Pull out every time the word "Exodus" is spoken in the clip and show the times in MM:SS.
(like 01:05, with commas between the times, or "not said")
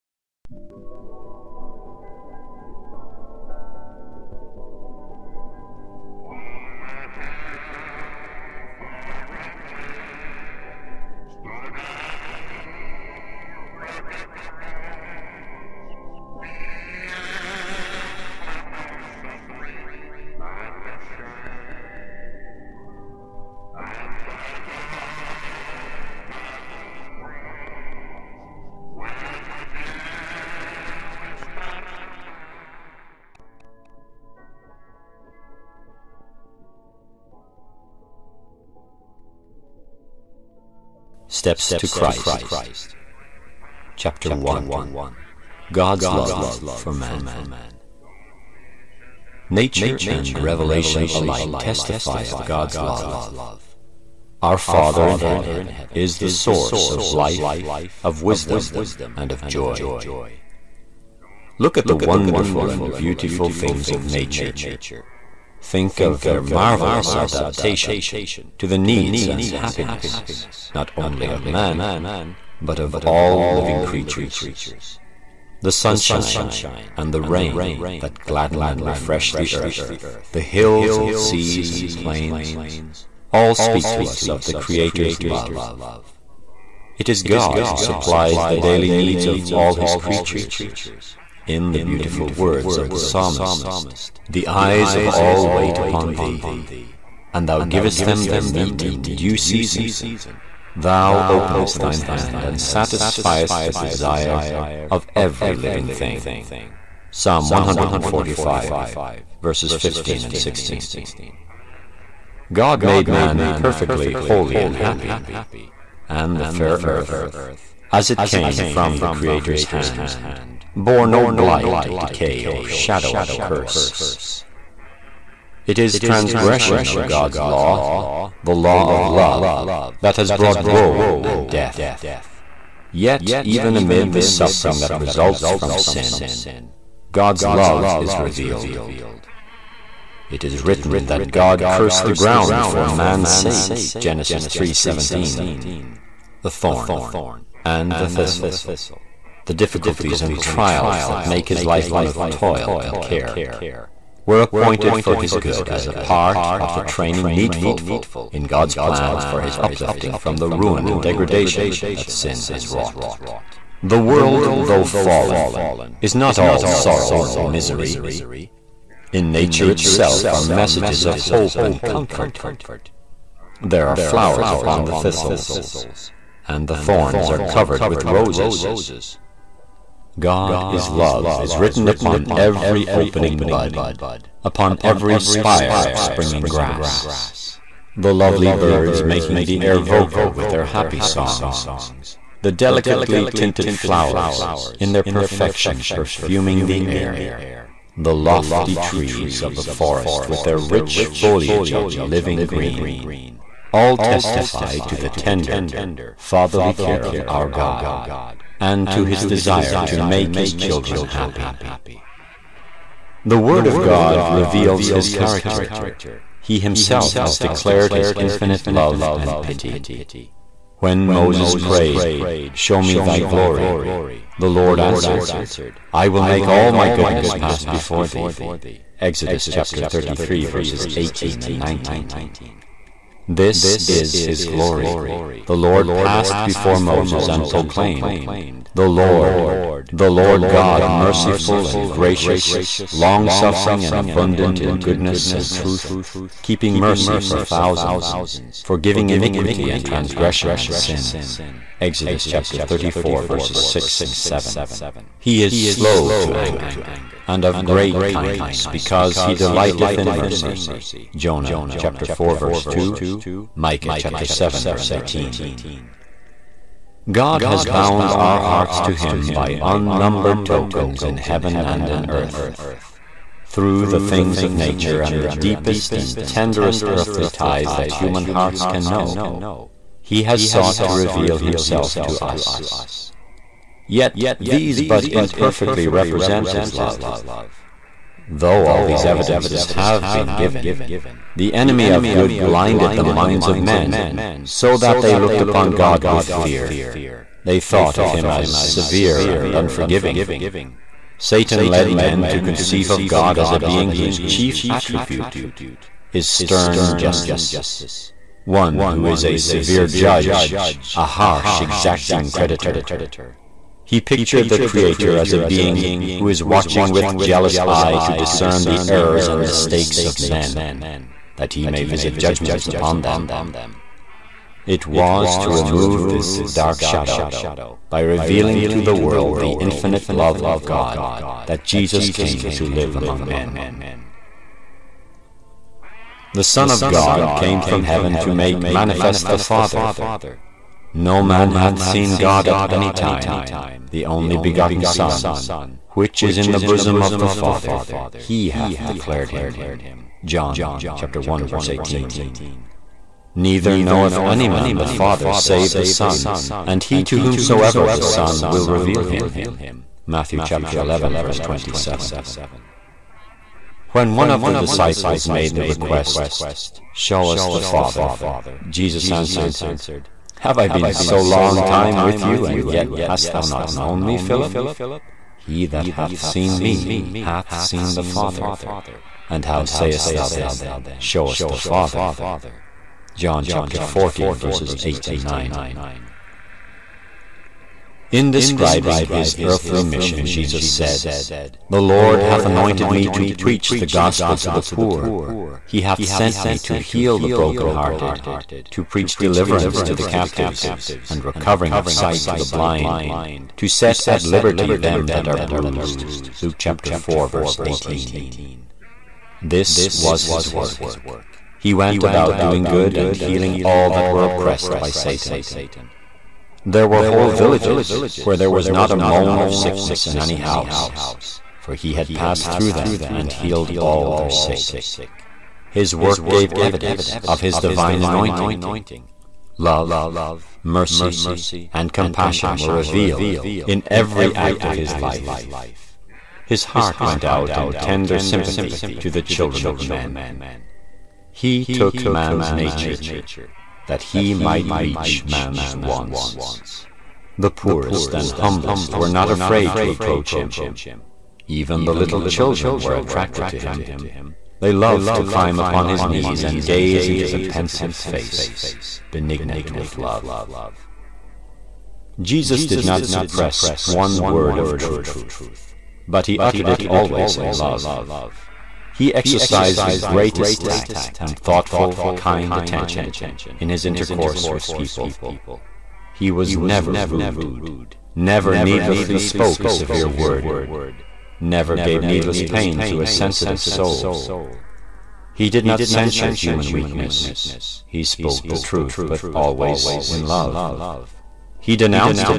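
03:48, 04:11.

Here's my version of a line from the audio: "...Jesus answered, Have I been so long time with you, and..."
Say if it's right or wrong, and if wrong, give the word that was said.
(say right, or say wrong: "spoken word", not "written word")
right.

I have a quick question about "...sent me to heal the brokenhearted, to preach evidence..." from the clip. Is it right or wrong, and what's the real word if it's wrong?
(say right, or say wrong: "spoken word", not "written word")
wrong: "deliverance", not "evidence".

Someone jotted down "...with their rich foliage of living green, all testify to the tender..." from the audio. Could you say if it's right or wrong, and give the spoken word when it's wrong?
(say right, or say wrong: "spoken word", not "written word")
right.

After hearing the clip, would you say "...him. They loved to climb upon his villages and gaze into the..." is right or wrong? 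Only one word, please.
wrong.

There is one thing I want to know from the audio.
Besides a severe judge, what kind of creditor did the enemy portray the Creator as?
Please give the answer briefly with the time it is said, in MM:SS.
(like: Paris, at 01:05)
harsh, exacting creditor, at 05:11.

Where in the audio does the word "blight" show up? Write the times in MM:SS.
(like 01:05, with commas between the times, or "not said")
02:01.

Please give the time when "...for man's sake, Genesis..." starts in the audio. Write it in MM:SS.
02:22.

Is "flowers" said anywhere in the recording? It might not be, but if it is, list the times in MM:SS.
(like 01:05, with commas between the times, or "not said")
02:53, 03:13.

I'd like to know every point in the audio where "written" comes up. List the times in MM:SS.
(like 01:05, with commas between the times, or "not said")
02:20, 03:01.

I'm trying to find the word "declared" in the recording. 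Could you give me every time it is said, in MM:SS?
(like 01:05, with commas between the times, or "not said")
03:37, 05:48.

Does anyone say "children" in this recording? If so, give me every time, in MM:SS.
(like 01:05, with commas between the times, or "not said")
03:30, 07:19, 07:32.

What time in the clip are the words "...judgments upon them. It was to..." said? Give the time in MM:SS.
05:22.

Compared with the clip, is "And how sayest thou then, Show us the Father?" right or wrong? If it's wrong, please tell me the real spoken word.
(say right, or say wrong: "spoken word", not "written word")
right.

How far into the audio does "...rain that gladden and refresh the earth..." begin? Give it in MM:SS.
01:17.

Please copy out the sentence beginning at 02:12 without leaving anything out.
Yet, even amid the suffering that results from sin, God's love is revealed.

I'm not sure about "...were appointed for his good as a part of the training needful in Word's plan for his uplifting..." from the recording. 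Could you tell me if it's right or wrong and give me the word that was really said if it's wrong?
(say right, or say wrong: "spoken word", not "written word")
wrong: "God", not "Word".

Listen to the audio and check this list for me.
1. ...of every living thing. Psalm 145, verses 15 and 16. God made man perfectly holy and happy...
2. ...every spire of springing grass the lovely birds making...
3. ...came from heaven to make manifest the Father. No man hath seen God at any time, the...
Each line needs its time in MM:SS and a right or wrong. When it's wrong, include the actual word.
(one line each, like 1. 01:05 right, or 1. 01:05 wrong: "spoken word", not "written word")
1. 01:44 right
2. 03:04 right
3. 05:37 right.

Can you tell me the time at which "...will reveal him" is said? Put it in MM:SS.
05:58.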